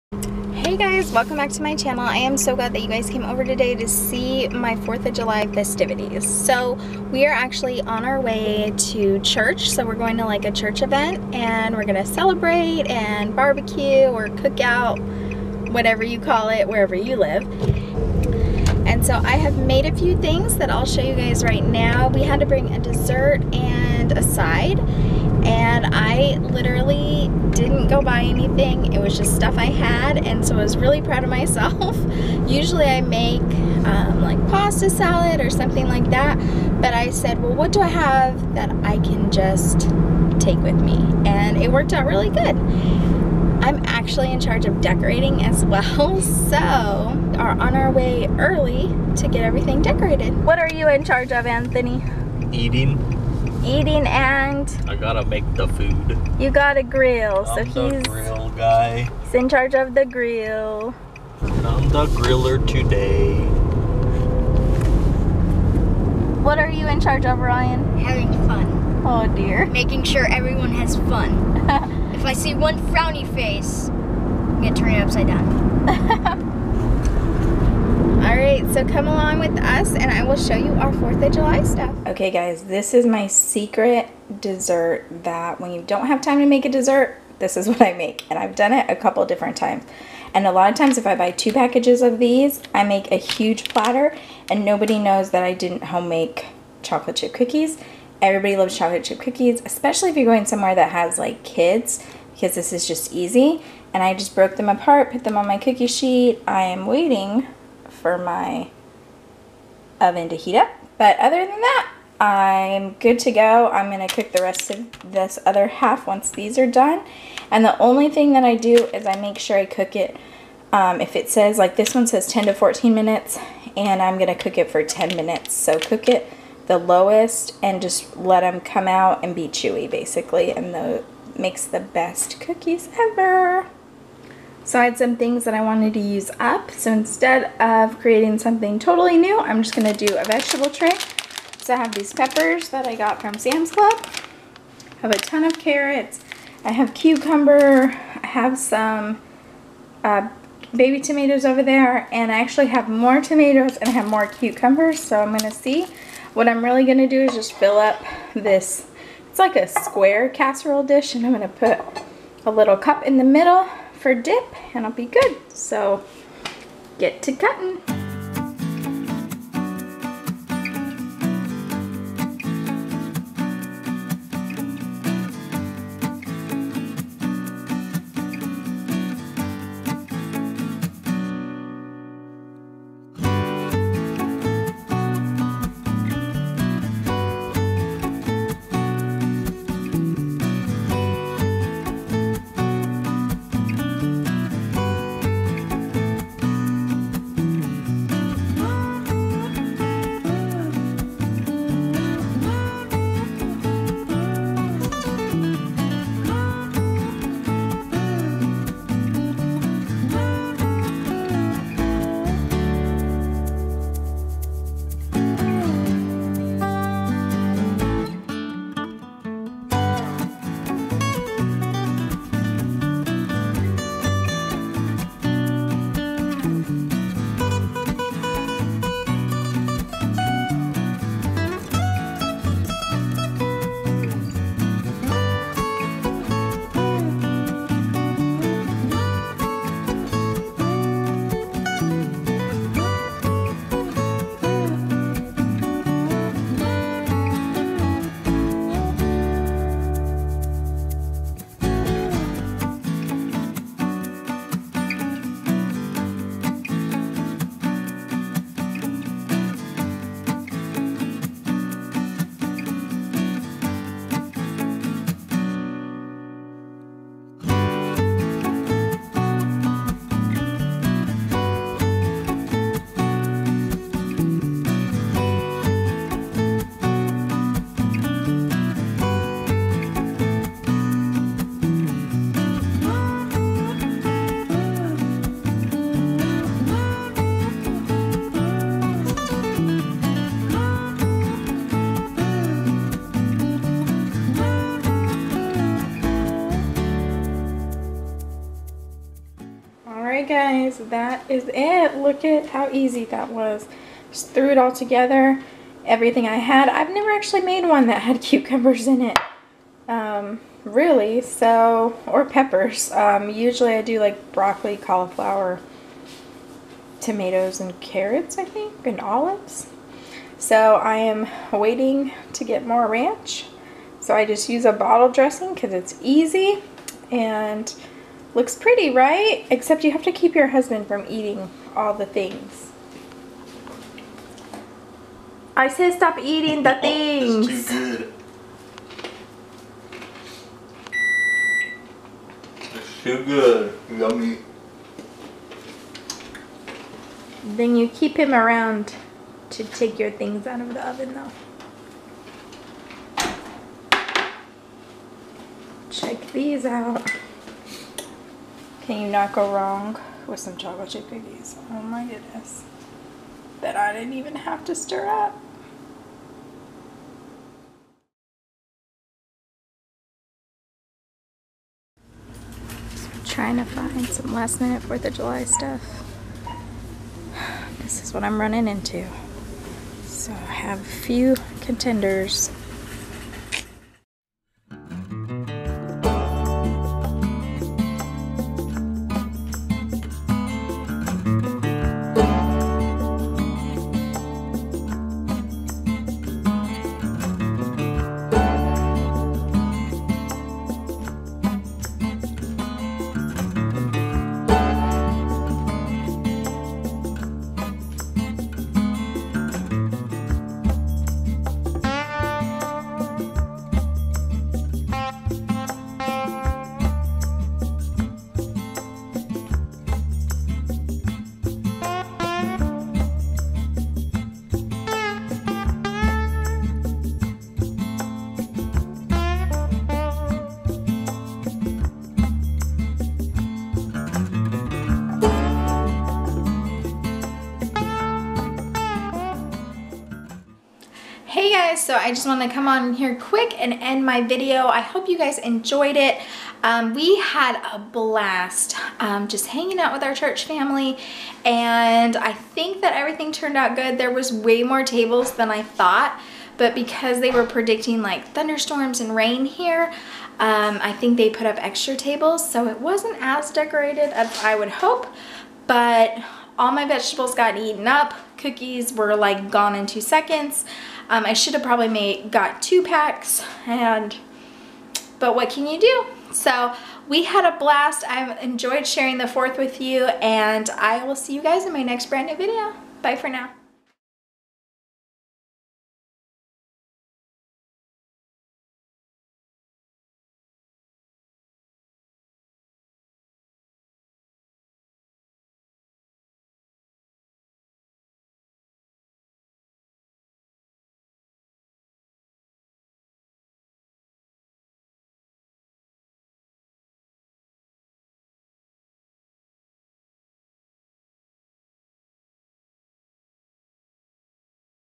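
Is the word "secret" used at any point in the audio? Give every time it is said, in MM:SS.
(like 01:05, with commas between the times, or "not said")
01:23.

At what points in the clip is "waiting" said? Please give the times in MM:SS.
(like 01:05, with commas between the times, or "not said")
01:46, 05:21.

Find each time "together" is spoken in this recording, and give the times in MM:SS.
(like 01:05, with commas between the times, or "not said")
05:04.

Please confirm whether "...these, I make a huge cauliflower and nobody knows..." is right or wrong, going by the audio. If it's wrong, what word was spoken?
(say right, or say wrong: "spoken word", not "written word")
wrong: "platter", not "cauliflower".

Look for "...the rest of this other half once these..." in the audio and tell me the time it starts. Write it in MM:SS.
01:54.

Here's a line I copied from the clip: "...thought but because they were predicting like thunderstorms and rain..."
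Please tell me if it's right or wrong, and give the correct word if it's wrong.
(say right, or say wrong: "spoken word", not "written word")
right.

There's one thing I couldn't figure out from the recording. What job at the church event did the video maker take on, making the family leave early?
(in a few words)
Decorating.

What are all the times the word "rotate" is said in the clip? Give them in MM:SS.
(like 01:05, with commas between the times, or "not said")
not said.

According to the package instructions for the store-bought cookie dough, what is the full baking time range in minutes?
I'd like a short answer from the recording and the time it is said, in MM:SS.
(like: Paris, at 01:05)
10 to 14 minutes, at 02:02.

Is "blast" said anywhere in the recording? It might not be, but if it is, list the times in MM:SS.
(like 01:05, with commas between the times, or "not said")
07:27, 07:57.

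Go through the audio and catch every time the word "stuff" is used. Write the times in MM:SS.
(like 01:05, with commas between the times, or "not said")
00:29, 01:21, 06:15.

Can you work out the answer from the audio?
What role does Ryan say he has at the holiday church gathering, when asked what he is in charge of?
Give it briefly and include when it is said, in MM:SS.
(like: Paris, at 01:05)
Having fun, at 01:07.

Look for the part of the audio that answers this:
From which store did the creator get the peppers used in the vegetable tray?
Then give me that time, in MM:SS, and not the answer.
02:23.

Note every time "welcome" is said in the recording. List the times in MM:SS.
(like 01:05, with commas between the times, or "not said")
00:01.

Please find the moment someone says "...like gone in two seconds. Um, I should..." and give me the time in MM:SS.
07:49.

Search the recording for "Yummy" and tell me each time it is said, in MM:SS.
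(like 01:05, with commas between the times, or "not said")
05:43.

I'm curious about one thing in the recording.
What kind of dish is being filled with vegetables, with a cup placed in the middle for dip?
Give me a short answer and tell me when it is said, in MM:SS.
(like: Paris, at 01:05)
Square casserole dish, at 02:39.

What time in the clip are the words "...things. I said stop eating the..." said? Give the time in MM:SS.
05:32.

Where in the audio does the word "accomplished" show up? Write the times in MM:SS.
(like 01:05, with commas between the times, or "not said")
not said.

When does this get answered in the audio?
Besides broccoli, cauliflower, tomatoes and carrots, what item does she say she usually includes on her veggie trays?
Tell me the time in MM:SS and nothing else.
05:18.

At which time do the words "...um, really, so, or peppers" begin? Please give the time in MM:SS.
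05:09.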